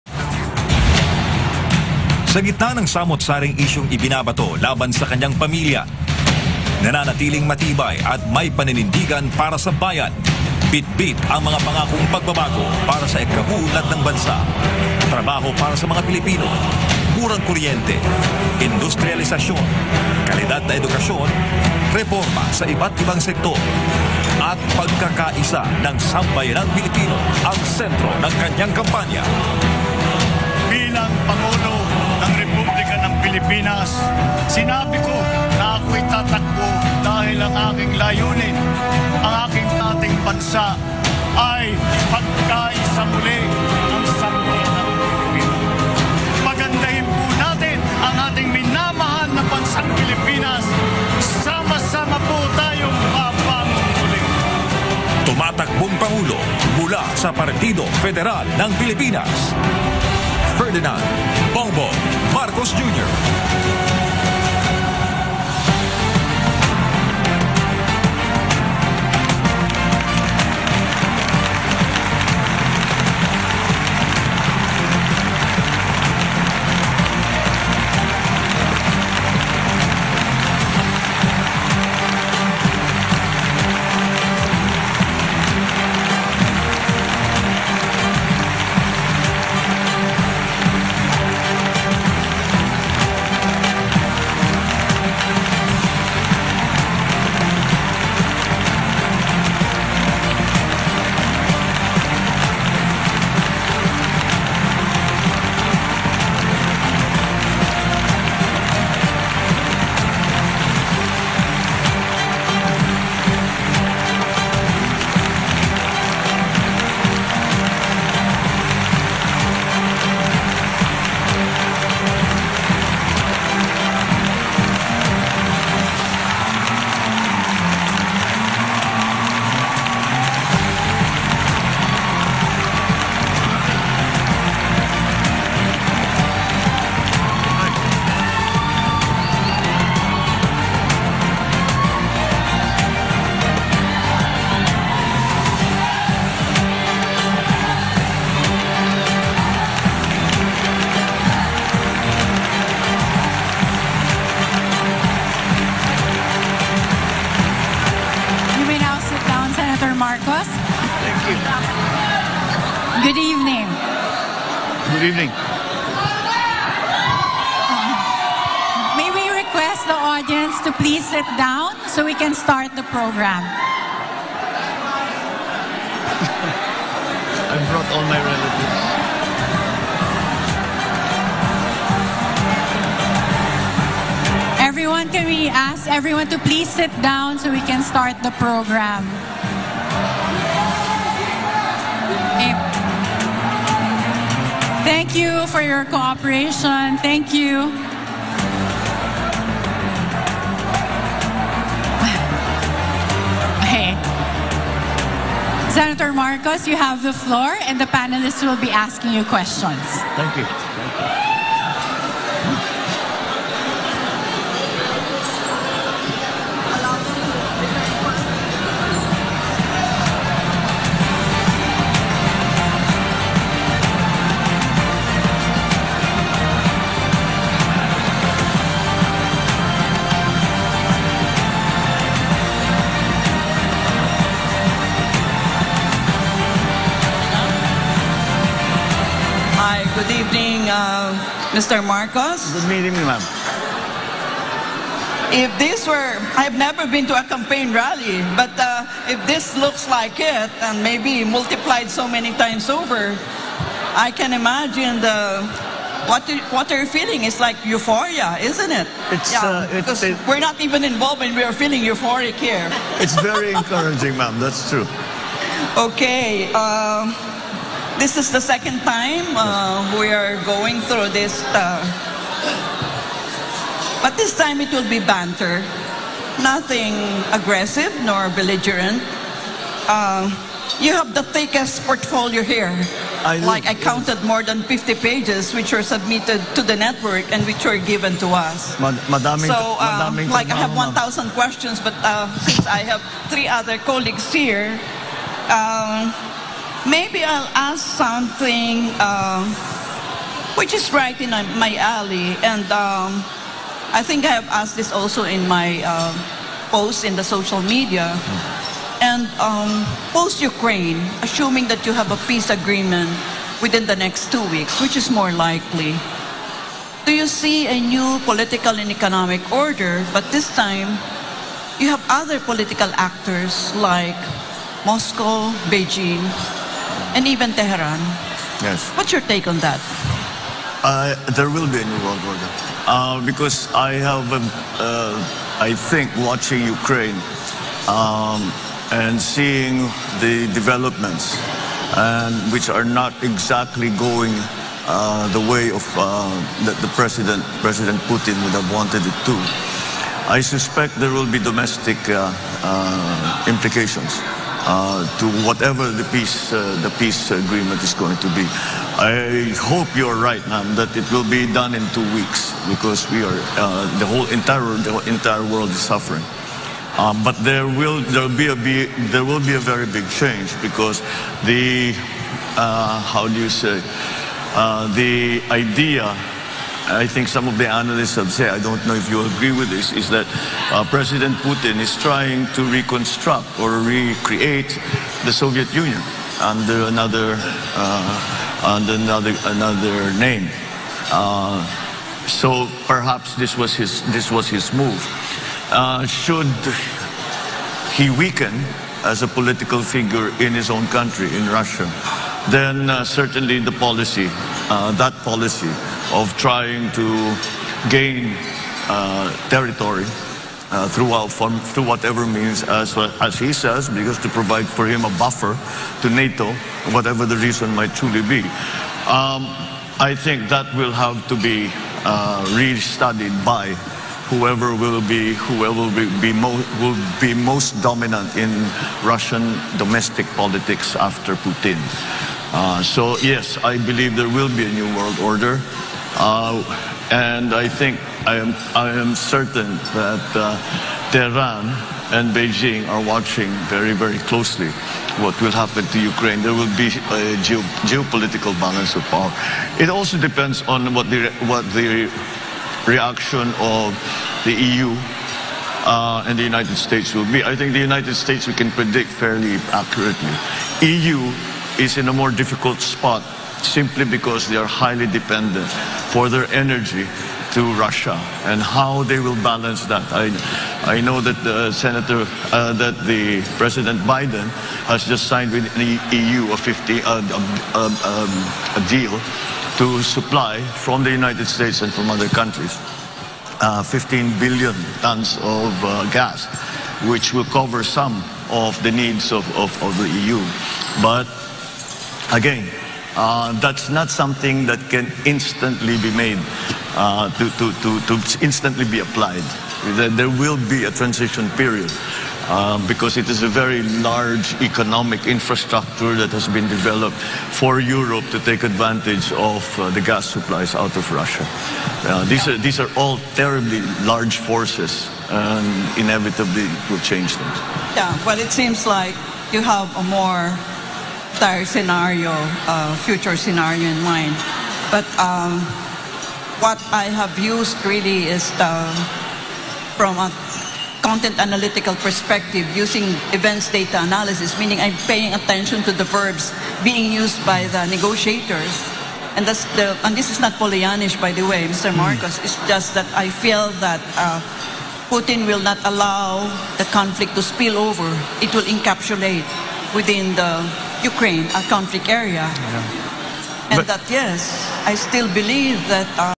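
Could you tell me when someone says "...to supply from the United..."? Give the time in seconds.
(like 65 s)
479 s.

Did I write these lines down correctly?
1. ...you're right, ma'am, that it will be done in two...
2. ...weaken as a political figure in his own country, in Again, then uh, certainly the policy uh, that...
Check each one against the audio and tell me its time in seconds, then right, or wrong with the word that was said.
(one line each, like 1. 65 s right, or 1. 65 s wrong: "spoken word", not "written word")
1. 359 s right
2. 398 s wrong: "Russia", not "Again".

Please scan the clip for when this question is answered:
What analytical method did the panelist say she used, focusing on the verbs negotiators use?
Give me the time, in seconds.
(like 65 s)
533 s.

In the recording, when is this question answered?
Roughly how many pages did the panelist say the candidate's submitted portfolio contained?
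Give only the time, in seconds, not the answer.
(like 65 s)
284 s.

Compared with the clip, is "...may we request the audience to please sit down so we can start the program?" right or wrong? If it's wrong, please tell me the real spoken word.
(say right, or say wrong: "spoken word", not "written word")
right.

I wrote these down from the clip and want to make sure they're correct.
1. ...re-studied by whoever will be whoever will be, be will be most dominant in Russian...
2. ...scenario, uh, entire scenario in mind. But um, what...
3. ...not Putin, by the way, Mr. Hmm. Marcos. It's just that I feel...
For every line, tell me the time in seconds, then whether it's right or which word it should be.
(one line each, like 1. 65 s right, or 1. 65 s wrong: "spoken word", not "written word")
1. 422 s right
2. 521 s wrong: "future", not "entire"
3. 540 s wrong: "Pollyannish", not "Putin".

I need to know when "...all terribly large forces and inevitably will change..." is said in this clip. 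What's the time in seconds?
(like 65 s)
512 s.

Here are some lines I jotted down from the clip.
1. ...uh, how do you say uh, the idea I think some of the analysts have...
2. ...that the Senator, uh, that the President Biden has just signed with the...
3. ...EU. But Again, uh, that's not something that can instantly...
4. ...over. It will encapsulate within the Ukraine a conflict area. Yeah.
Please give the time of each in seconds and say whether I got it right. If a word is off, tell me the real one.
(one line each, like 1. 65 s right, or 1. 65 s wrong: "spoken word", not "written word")
1. 372 s right
2. 471 s right
3. 490 s right
4. 547 s right.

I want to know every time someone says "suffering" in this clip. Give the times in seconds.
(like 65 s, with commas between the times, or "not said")
365 s.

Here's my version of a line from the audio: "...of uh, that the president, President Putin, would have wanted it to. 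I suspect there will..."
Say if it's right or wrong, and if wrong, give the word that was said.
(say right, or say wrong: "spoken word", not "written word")
right.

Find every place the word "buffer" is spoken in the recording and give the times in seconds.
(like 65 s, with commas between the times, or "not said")
415 s.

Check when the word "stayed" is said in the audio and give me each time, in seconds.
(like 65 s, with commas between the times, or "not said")
not said.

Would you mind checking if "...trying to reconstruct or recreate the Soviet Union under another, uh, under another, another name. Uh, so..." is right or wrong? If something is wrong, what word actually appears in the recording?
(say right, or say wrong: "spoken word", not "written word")
right.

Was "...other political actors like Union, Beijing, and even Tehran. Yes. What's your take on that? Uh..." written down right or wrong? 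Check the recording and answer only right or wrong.
wrong.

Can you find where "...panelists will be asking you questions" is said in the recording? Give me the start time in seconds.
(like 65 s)
207 s.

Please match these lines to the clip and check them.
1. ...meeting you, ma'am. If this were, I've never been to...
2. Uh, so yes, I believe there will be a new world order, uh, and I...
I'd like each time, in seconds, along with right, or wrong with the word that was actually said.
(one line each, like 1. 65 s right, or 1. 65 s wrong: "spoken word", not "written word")
1. 242 s right
2. 432 s right.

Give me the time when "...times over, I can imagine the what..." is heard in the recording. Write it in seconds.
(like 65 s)
252 s.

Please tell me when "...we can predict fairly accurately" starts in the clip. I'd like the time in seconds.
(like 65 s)
458 s.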